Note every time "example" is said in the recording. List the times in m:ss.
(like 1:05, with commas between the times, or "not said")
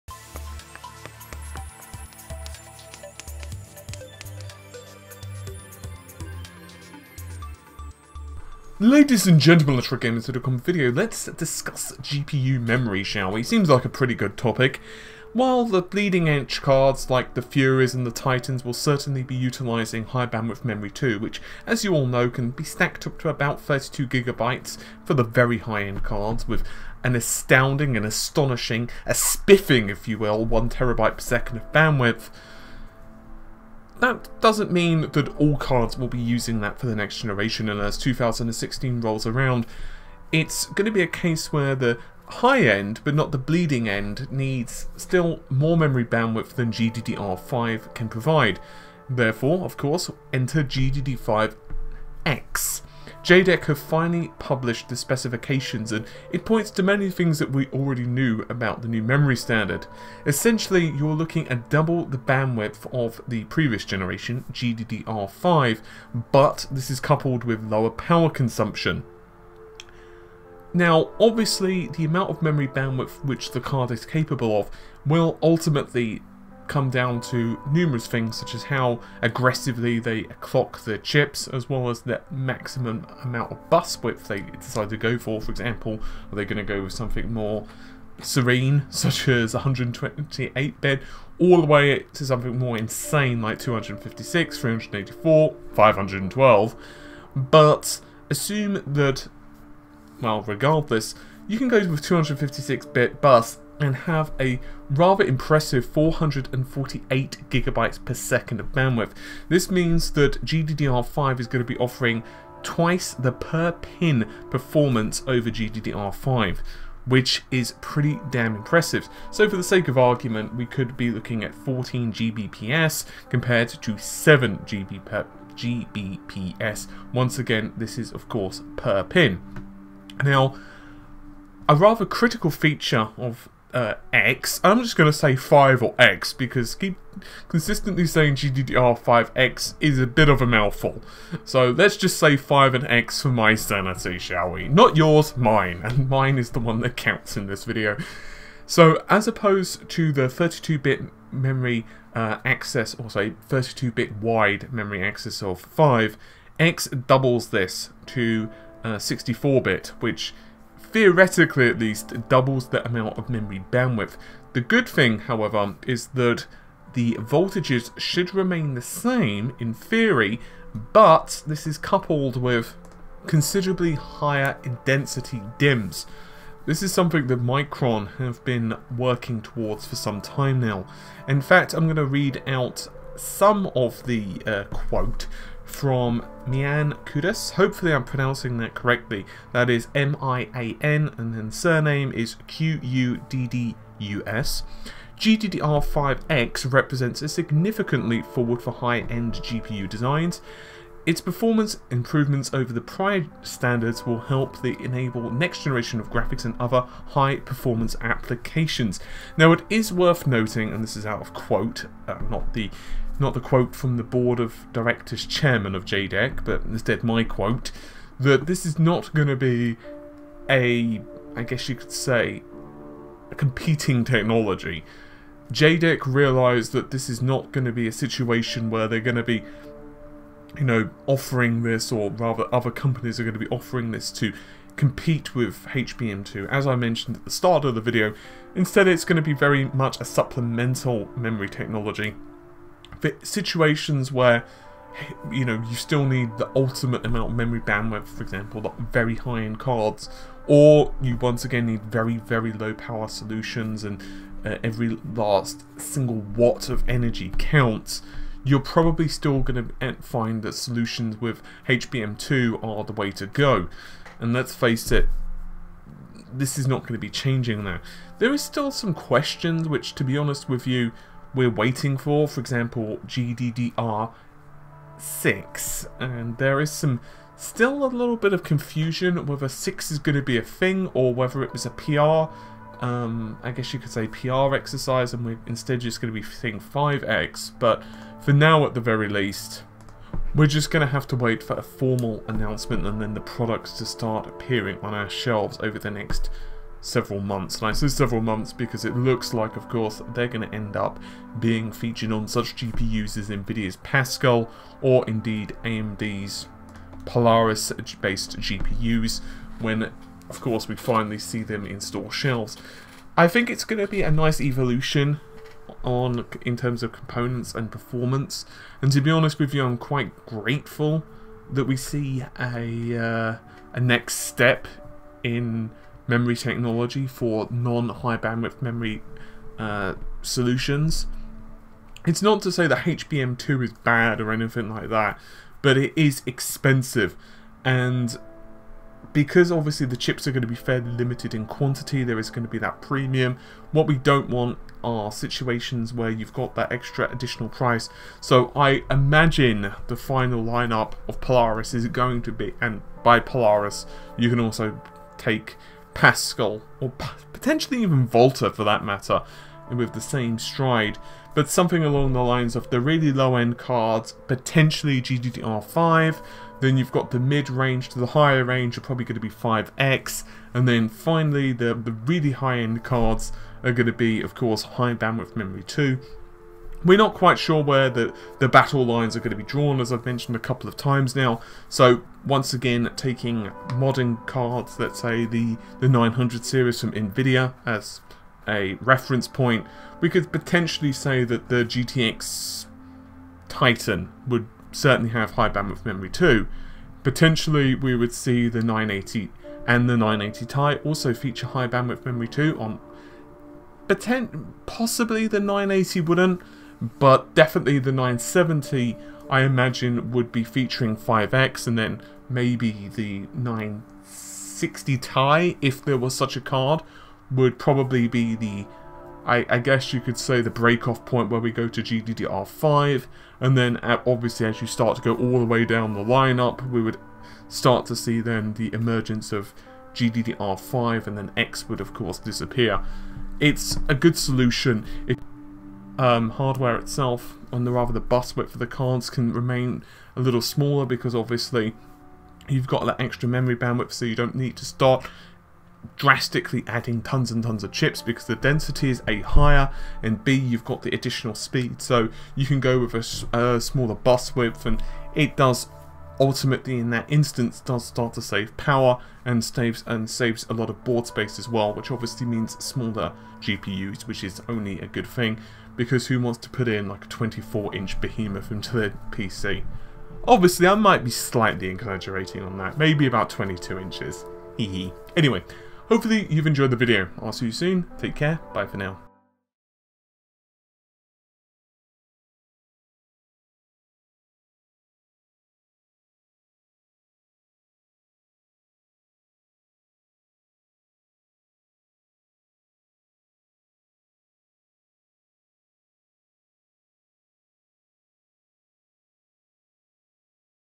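1:25, 4:08, 4:32.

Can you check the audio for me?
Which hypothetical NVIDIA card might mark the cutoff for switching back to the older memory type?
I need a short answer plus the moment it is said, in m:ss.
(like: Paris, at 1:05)
960 Ti, at 6:53.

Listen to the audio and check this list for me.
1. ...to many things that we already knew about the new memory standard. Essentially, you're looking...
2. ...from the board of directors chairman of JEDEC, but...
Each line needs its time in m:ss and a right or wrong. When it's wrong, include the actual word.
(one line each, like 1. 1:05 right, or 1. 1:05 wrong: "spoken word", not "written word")
1. 0:56 right
2. 3:33 right.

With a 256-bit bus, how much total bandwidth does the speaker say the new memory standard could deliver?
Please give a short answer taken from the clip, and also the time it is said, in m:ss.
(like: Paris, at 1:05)
448 GB/s, at 1:45.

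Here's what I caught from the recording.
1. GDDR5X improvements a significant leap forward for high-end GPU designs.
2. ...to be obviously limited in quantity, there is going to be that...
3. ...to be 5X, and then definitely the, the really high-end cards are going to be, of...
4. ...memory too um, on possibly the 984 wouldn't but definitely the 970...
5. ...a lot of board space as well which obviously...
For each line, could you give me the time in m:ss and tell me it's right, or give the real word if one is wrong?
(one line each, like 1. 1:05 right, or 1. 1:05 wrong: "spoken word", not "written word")
1. 3:15 wrong: "represents", not "improvements"
2. 5:40 wrong: "fairly", not "obviously"
3. 6:09 wrong: "finally", not "definitely"
4. 6:42 wrong: "980", not "984"
5. 7:40 right.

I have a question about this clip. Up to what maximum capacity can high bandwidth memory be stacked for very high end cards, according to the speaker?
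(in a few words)
32GB.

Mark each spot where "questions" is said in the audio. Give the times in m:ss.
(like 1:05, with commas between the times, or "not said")
4:28.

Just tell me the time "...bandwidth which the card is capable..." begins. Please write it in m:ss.
1:12.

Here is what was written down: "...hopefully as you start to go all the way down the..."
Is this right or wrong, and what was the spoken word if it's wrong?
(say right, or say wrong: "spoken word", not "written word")
wrong: "obviously", not "hopefully".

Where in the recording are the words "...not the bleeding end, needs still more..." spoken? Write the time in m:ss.
0:43.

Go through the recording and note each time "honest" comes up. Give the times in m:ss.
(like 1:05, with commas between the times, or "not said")
4:30, 5:19.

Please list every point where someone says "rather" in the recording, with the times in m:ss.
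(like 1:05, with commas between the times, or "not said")
1:44, 2:11, 3:52, 7:17.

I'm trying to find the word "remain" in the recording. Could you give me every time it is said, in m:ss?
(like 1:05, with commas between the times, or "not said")
2:48, 7:19.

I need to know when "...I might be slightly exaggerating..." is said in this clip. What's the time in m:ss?
7:50.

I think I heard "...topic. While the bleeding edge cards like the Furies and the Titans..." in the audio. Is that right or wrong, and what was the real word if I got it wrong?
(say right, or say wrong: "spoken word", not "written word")
right.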